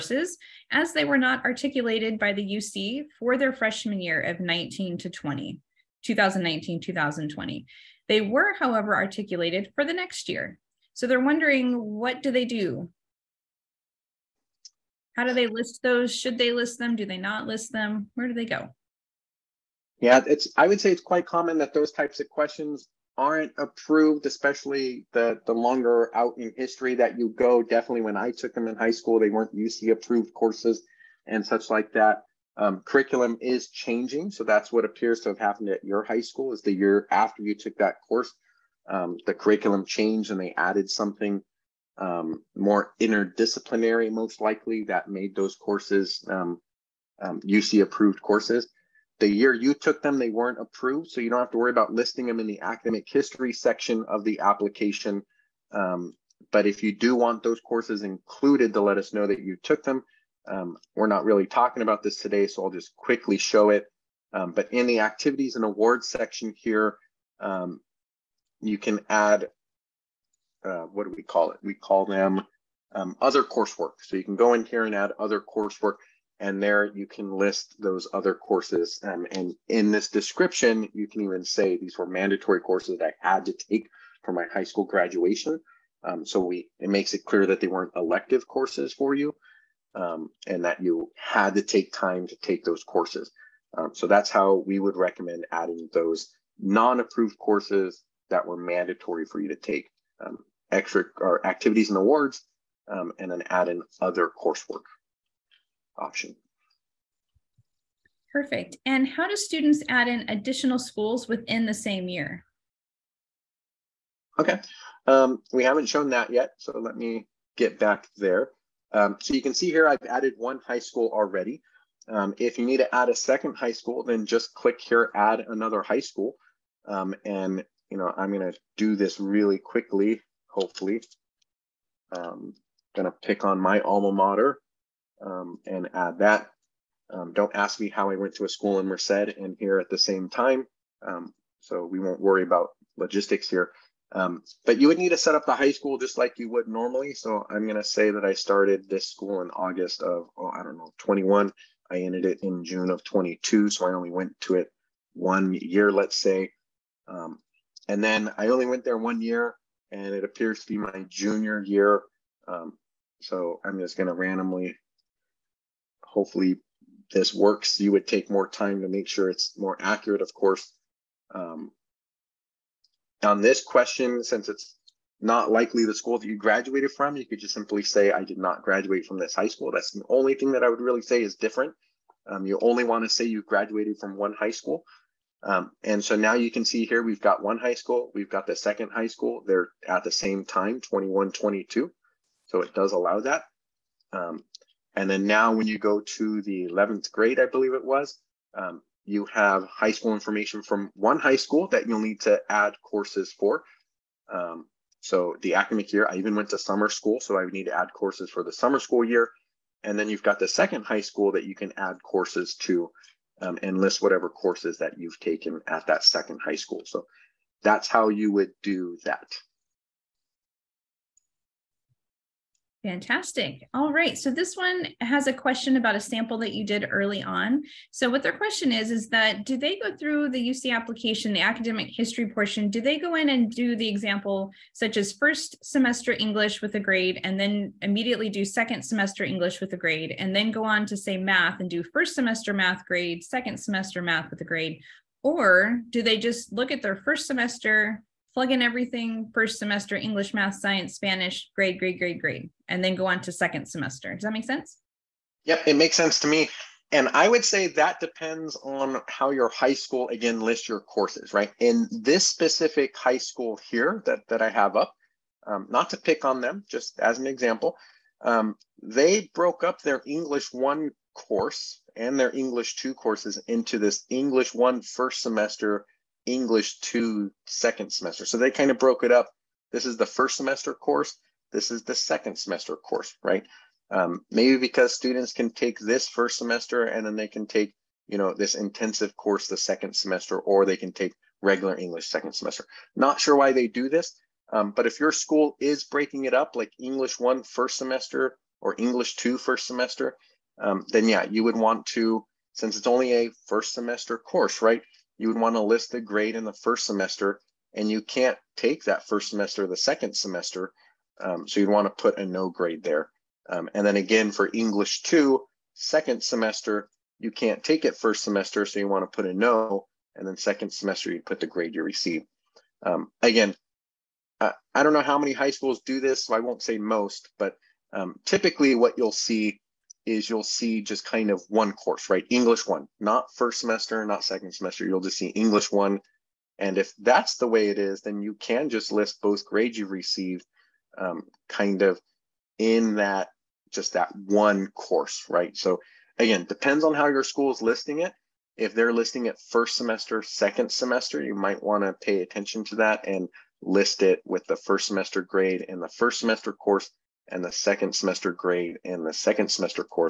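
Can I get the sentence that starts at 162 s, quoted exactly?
Um, so I'm just going to randomly, hopefully, this works.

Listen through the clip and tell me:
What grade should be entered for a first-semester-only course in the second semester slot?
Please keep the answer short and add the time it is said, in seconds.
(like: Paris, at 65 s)
No grade, at 312 s.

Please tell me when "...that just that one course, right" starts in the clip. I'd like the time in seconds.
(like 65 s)
342 s.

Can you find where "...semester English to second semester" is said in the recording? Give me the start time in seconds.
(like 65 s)
275 s.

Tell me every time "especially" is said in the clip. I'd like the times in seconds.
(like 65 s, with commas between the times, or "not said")
24 s.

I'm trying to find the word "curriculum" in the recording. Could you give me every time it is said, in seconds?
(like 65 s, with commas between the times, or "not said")
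32 s, 39 s.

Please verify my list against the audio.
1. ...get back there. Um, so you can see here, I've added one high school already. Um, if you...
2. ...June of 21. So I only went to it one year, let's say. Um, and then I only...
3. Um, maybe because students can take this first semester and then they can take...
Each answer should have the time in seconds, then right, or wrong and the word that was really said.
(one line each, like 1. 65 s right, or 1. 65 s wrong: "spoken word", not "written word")
1. 117 s right
2. 152 s wrong: "22", not "21"
3. 283 s right.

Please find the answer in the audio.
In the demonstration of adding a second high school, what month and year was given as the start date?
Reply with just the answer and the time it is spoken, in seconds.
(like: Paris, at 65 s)
August 2021, at 149 s.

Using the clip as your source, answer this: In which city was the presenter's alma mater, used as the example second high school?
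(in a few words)
Merced.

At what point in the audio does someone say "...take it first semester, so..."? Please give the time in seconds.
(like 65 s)
317 s.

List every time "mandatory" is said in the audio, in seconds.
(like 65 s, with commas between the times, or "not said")
82 s, 98 s.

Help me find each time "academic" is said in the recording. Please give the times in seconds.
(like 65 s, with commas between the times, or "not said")
52 s, 205 s, 231 s.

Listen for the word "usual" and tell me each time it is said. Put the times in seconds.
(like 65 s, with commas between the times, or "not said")
not said.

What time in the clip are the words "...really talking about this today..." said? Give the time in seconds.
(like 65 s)
61 s.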